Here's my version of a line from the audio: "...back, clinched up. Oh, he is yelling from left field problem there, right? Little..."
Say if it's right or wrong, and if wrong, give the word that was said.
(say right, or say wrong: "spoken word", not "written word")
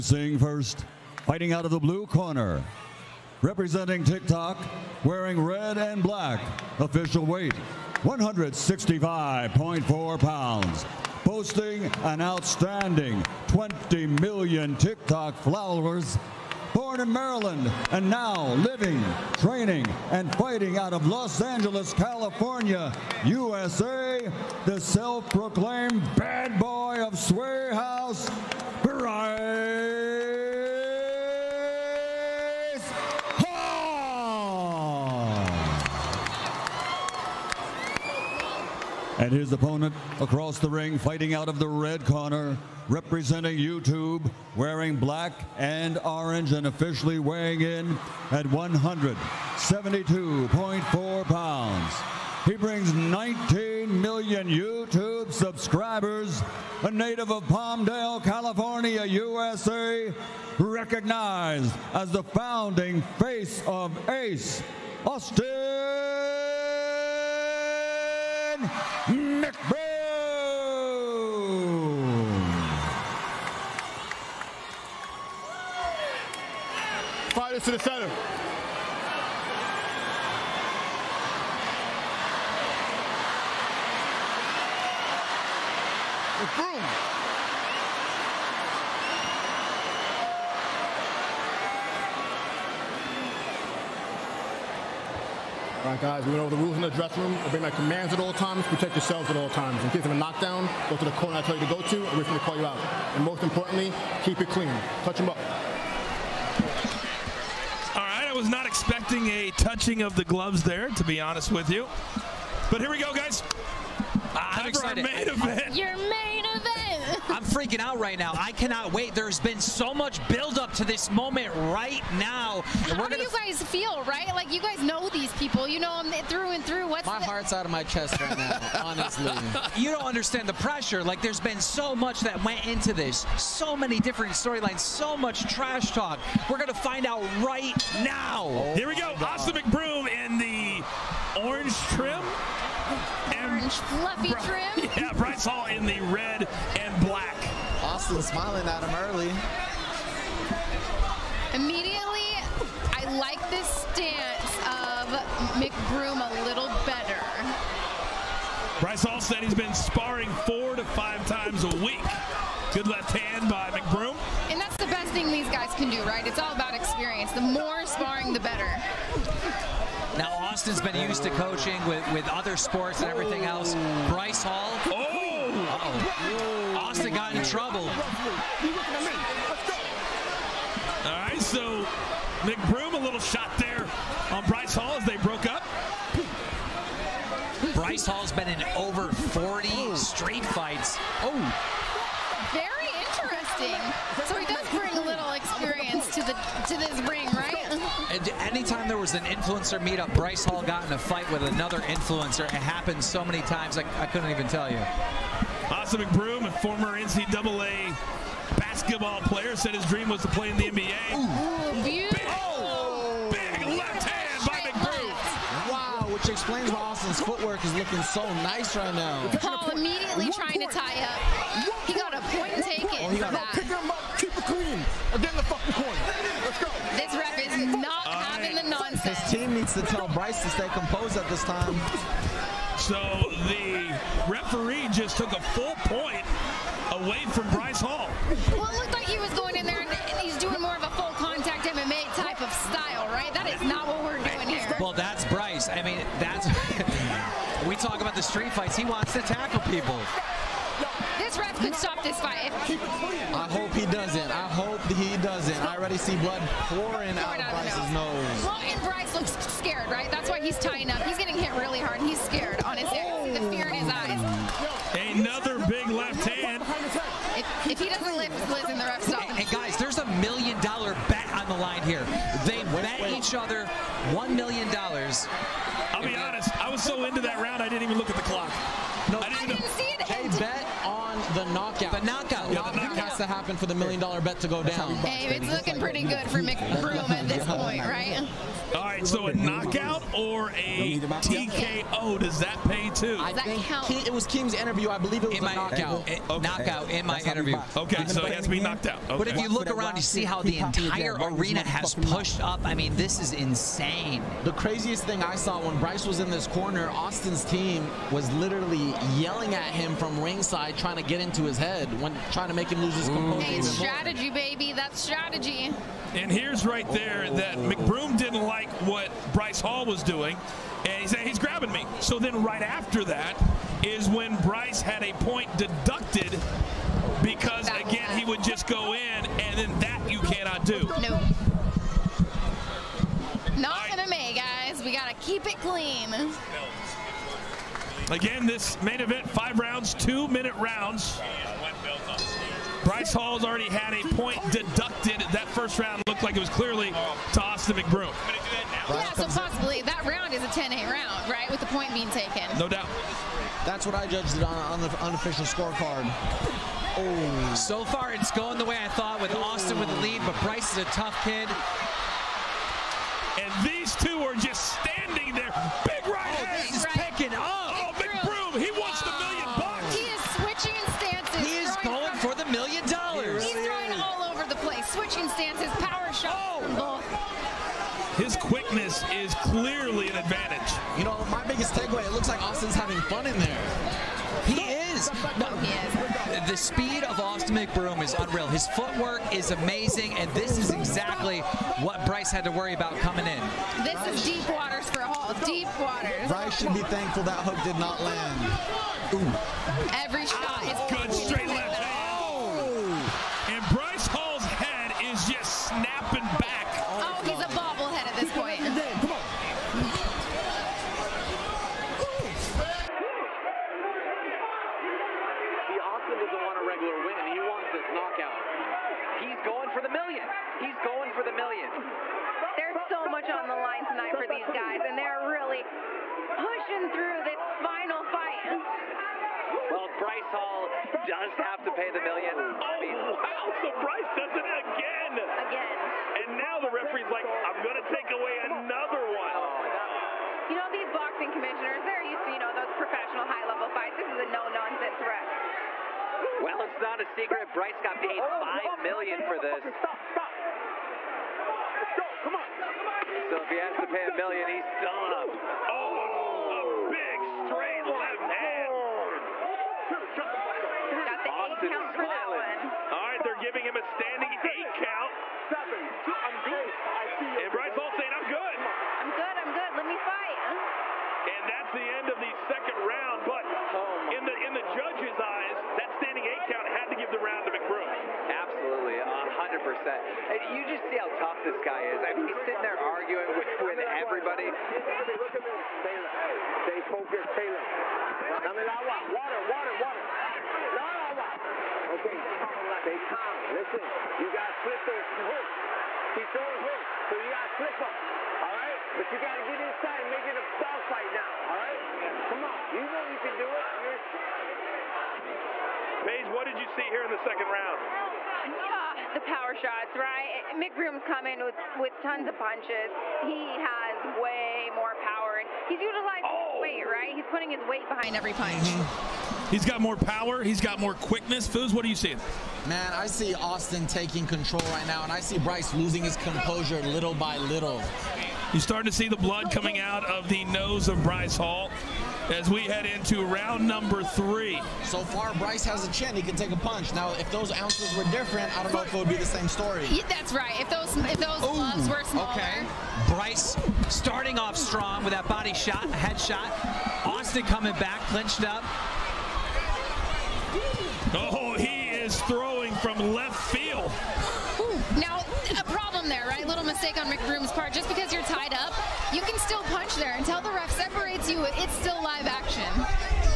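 wrong: "throwing", not "yelling".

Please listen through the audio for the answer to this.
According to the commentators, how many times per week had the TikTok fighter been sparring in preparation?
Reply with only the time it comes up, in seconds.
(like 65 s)
160 s.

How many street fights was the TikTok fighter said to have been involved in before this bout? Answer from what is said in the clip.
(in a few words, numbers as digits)
over 40.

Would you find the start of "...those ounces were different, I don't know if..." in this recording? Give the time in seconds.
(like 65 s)
537 s.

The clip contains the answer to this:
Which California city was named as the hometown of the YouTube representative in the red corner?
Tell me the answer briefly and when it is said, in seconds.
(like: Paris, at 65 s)
Palmdale, at 57 s.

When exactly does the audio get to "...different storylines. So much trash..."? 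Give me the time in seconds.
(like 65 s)
134 s.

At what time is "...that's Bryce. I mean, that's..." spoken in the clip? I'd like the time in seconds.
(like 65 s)
244 s.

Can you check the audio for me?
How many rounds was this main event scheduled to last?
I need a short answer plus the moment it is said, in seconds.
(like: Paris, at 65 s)
5, at 339 s.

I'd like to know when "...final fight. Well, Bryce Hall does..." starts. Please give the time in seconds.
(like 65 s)
427 s.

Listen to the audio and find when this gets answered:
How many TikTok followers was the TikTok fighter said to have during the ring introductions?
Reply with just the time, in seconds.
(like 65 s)
13 s.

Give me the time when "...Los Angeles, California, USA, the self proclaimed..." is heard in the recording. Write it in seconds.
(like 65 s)
21 s.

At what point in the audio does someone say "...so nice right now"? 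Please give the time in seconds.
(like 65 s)
218 s.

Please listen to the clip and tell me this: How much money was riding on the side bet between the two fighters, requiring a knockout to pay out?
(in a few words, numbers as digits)
$1 million.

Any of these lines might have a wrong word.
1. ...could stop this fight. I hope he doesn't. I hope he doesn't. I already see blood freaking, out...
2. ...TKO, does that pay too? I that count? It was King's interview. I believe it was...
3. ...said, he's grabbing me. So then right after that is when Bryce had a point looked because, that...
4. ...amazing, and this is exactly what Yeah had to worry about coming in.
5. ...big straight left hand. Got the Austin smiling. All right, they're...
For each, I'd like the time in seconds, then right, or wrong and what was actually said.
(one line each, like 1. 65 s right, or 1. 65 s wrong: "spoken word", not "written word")
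1. 251 s wrong: "pouring", not "freaking"
2. 290 s right
3. 321 s wrong: "deducted", not "looked"
4. 389 s wrong: "Bryce", not "Yeah"
5. 456 s right.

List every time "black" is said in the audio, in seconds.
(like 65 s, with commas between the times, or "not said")
6 s, 44 s, 147 s.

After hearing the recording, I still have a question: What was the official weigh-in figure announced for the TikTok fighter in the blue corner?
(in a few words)
165.4 pounds.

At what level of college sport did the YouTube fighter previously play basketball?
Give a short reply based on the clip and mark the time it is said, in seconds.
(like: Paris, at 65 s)
NCAA, at 206 s.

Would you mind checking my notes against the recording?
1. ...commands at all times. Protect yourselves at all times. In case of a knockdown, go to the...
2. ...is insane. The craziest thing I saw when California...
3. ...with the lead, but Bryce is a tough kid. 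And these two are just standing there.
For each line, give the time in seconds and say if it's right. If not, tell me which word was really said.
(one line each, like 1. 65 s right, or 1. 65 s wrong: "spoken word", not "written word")
1. 97 s right
2. 303 s wrong: "Bryce", not "California"
3. 359 s right.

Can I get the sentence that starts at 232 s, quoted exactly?
So the referee just took a full point away from Bryce Hall.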